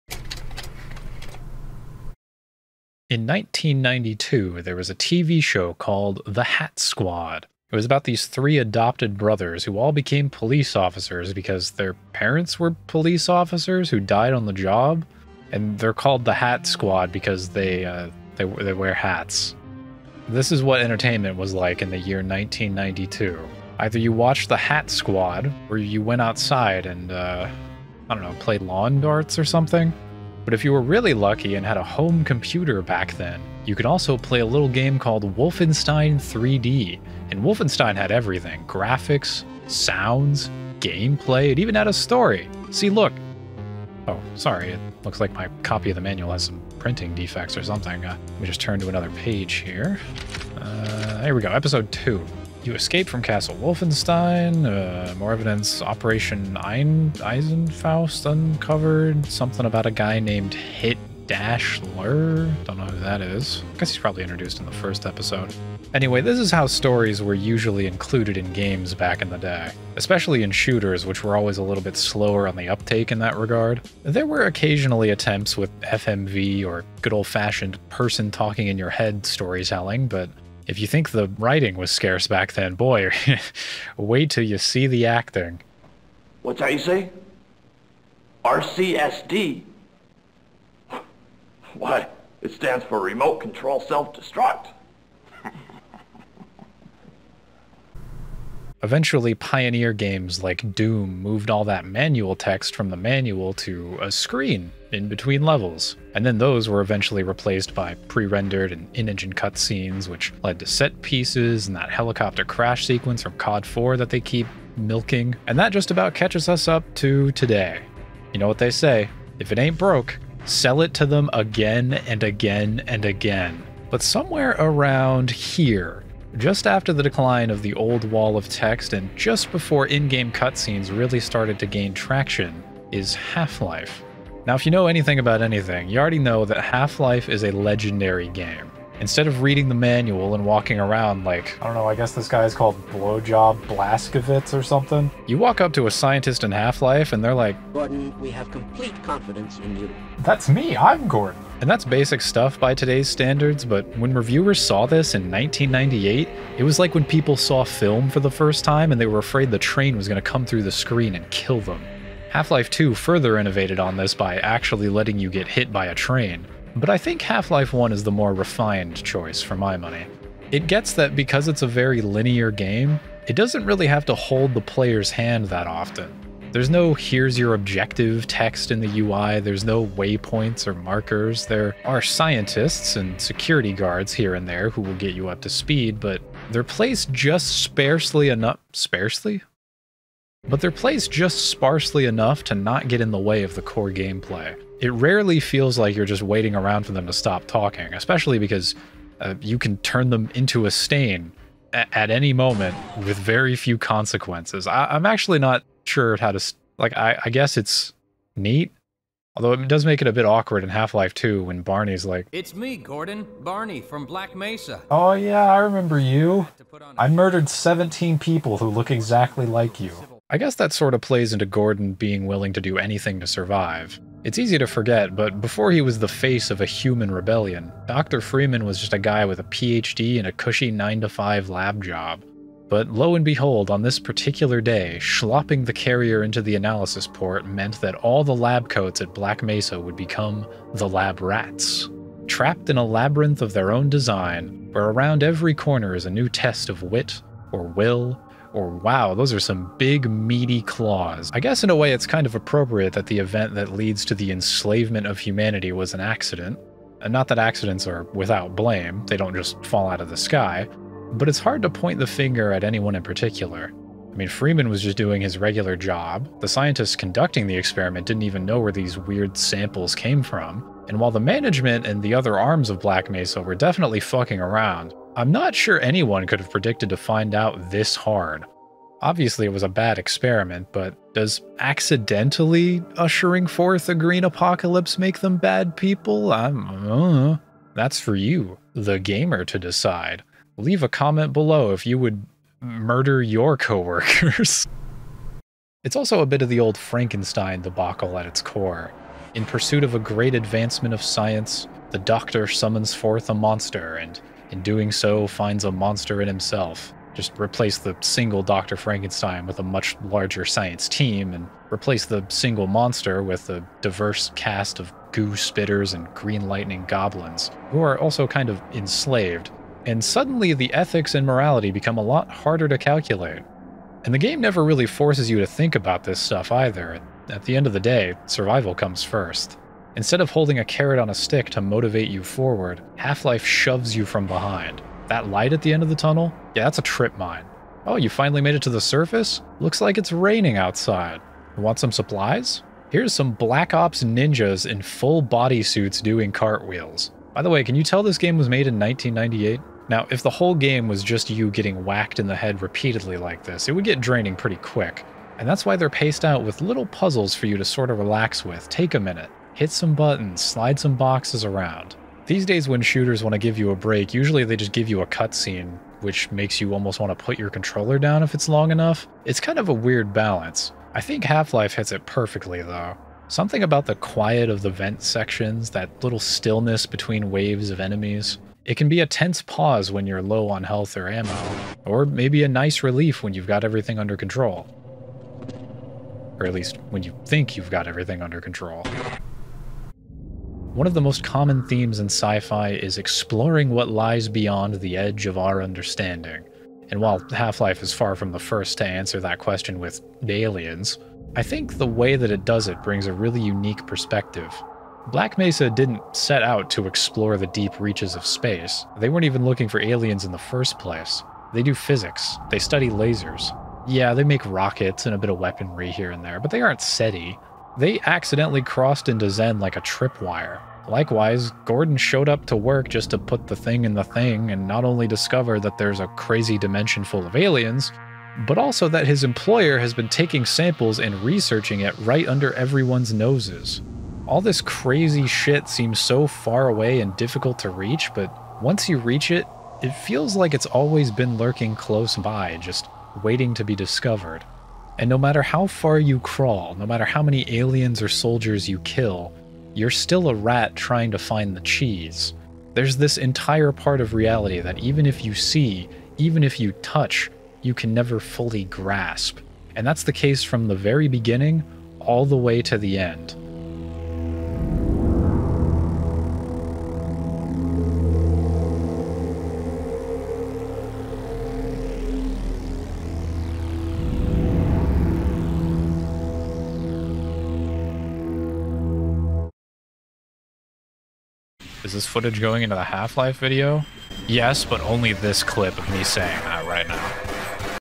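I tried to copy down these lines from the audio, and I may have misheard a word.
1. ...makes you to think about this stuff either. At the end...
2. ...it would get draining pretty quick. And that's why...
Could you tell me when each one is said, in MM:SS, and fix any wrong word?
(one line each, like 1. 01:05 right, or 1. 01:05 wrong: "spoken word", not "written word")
1. 05:24 wrong: "forces", not "makes"
2. 05:53 right.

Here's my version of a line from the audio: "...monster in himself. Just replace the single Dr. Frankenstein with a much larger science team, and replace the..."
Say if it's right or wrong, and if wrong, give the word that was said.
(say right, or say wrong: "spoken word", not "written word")
right.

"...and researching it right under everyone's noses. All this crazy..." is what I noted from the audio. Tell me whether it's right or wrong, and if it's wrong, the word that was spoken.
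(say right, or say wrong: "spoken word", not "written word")
right.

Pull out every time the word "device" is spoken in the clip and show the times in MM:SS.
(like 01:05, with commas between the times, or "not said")
not said.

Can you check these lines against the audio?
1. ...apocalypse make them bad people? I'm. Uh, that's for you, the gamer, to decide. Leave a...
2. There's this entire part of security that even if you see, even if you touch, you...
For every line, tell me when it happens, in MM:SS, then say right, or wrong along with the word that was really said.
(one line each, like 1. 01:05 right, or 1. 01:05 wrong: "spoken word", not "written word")
1. 04:44 right
2. 07:32 wrong: "reality", not "security".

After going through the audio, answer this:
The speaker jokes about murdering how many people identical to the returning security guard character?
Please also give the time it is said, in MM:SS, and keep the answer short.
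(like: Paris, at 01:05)
17, at 03:37.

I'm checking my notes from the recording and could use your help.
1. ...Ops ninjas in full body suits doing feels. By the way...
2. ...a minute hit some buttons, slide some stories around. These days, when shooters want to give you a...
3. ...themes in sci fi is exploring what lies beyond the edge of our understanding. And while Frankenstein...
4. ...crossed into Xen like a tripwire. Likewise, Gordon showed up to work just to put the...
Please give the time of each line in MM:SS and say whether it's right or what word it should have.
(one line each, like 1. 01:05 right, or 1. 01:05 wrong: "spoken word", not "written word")
1. 05:43 wrong: "cartwheels", not "feels"
2. 05:58 wrong: "boxes", not "stories"
3. 06:31 wrong: "Half", not "Frankenstein"
4. 06:58 right.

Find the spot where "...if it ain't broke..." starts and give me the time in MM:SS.
01:59.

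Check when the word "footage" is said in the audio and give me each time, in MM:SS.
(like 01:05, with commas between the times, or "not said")
08:02.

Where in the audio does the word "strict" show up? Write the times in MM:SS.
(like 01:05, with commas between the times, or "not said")
not said.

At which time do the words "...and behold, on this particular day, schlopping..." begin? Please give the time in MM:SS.
03:53.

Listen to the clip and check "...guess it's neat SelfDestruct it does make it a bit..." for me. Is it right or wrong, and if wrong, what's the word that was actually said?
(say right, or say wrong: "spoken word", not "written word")
wrong: "Although", not "SelfDestruct".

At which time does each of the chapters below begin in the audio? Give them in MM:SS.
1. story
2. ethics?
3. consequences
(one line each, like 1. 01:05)
1. 01:38
2. 04:55
3. 06:29.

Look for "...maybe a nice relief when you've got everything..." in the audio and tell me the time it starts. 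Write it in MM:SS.
06:22.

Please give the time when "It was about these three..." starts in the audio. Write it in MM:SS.
00:07.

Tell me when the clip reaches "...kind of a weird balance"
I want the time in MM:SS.
06:09.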